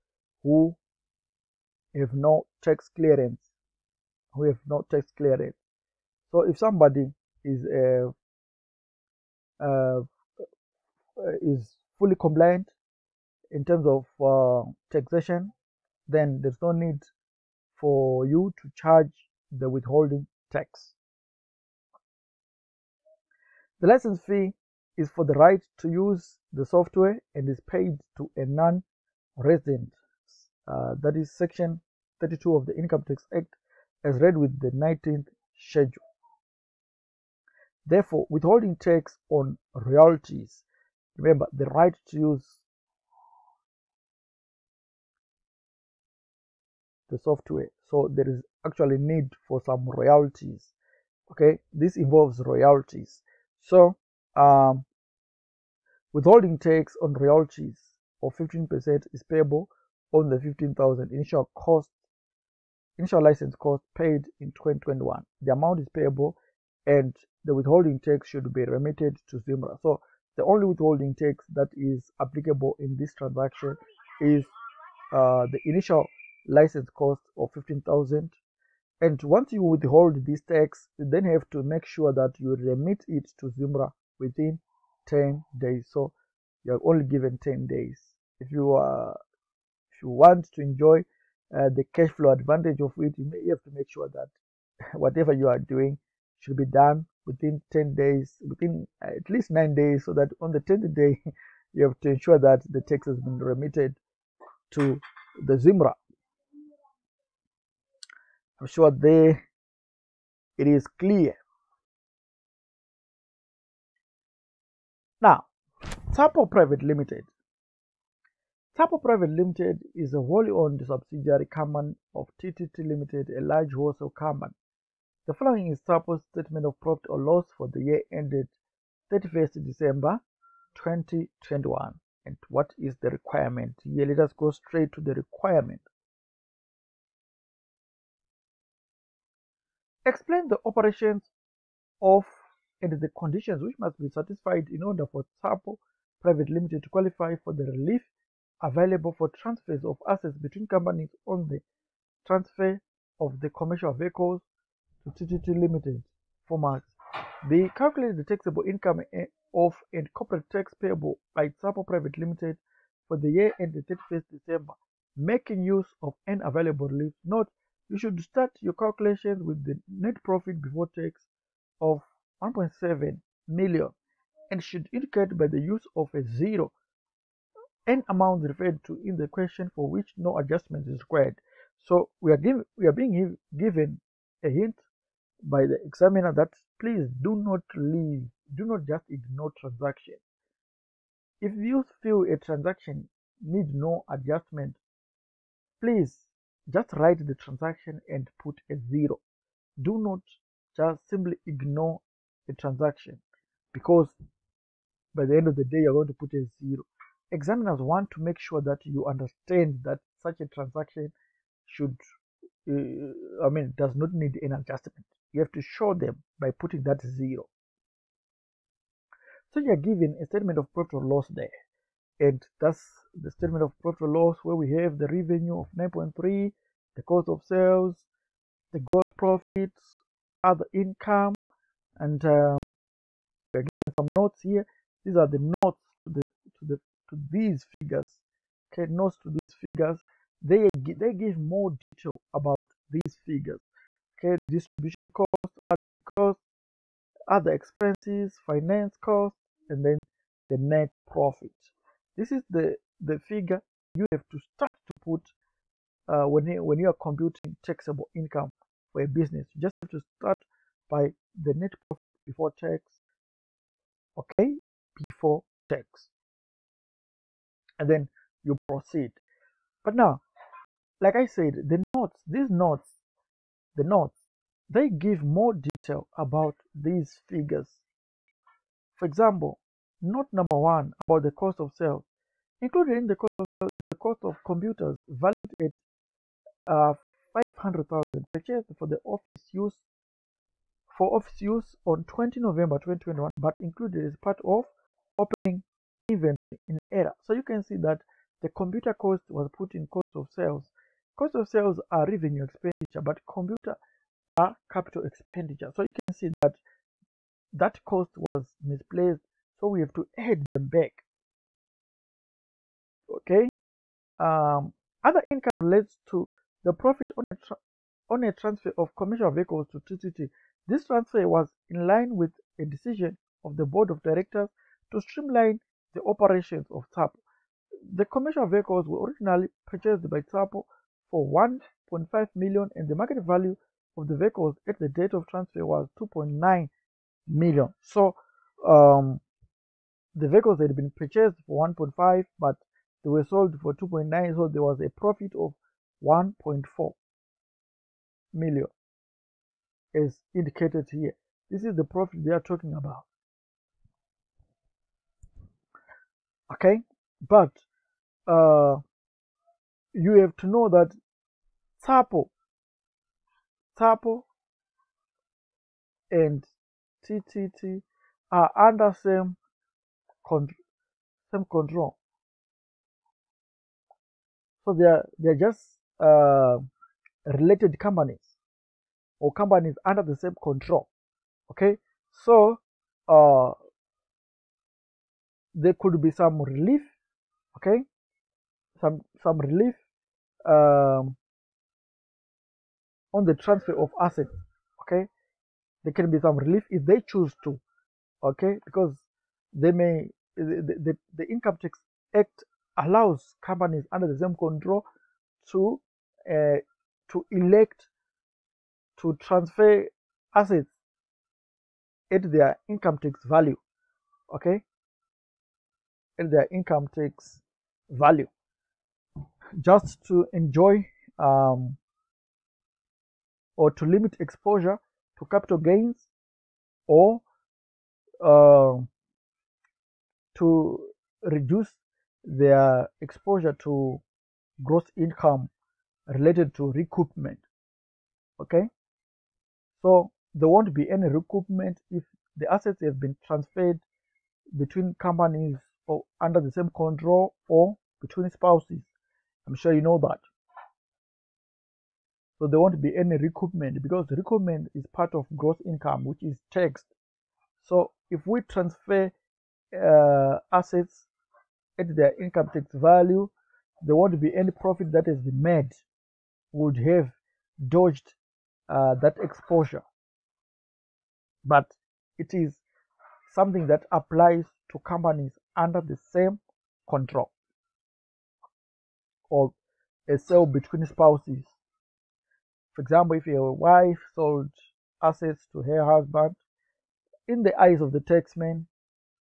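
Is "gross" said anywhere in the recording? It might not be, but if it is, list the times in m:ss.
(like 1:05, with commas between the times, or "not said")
3:48, 7:14, 7:35.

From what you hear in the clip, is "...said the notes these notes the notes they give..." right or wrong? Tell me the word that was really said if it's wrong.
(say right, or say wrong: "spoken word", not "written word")
right.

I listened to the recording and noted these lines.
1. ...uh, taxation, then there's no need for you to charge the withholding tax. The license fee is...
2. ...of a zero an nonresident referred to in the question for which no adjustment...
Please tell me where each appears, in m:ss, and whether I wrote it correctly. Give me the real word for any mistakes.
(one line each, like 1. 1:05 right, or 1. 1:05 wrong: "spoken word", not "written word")
1. 0:14 right
2. 2:55 wrong: "amount", not "nonresident".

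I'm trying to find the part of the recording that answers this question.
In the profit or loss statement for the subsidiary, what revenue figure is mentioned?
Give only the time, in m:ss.
3:45.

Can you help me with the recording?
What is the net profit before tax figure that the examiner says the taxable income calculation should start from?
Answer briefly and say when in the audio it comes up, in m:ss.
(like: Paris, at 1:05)
1.7 million, at 2:52.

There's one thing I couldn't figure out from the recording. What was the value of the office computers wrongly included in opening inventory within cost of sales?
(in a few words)
500,000.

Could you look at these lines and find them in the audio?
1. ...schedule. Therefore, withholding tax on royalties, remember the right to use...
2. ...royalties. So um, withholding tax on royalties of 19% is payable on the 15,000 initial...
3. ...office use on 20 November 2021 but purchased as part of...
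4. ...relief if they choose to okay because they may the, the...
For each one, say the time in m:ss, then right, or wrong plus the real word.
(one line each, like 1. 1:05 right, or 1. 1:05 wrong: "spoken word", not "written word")
1. 0:35 right
2. 0:52 wrong: "15", not "19"
3. 4:51 wrong: "included", not "purchased"
4. 6:36 right.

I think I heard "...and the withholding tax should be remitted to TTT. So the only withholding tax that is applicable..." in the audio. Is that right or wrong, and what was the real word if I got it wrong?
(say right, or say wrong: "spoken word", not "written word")
wrong: "Zimra", not "TTT".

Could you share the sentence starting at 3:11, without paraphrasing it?
If you feel a transaction needs no adjustment, please just write the transaction and put a zero.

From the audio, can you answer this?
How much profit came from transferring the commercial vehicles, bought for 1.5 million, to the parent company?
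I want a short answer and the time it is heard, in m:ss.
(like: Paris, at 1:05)
1.4 million, at 5:46.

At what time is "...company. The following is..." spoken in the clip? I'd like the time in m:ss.
2:04.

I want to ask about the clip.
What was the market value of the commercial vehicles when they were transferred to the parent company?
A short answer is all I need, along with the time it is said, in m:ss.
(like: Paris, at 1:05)
2.9 million, at 5:35.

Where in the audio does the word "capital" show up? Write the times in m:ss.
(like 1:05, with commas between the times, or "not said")
5:04, 7:05.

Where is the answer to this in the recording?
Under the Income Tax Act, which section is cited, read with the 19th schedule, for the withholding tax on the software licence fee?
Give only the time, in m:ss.
0:31.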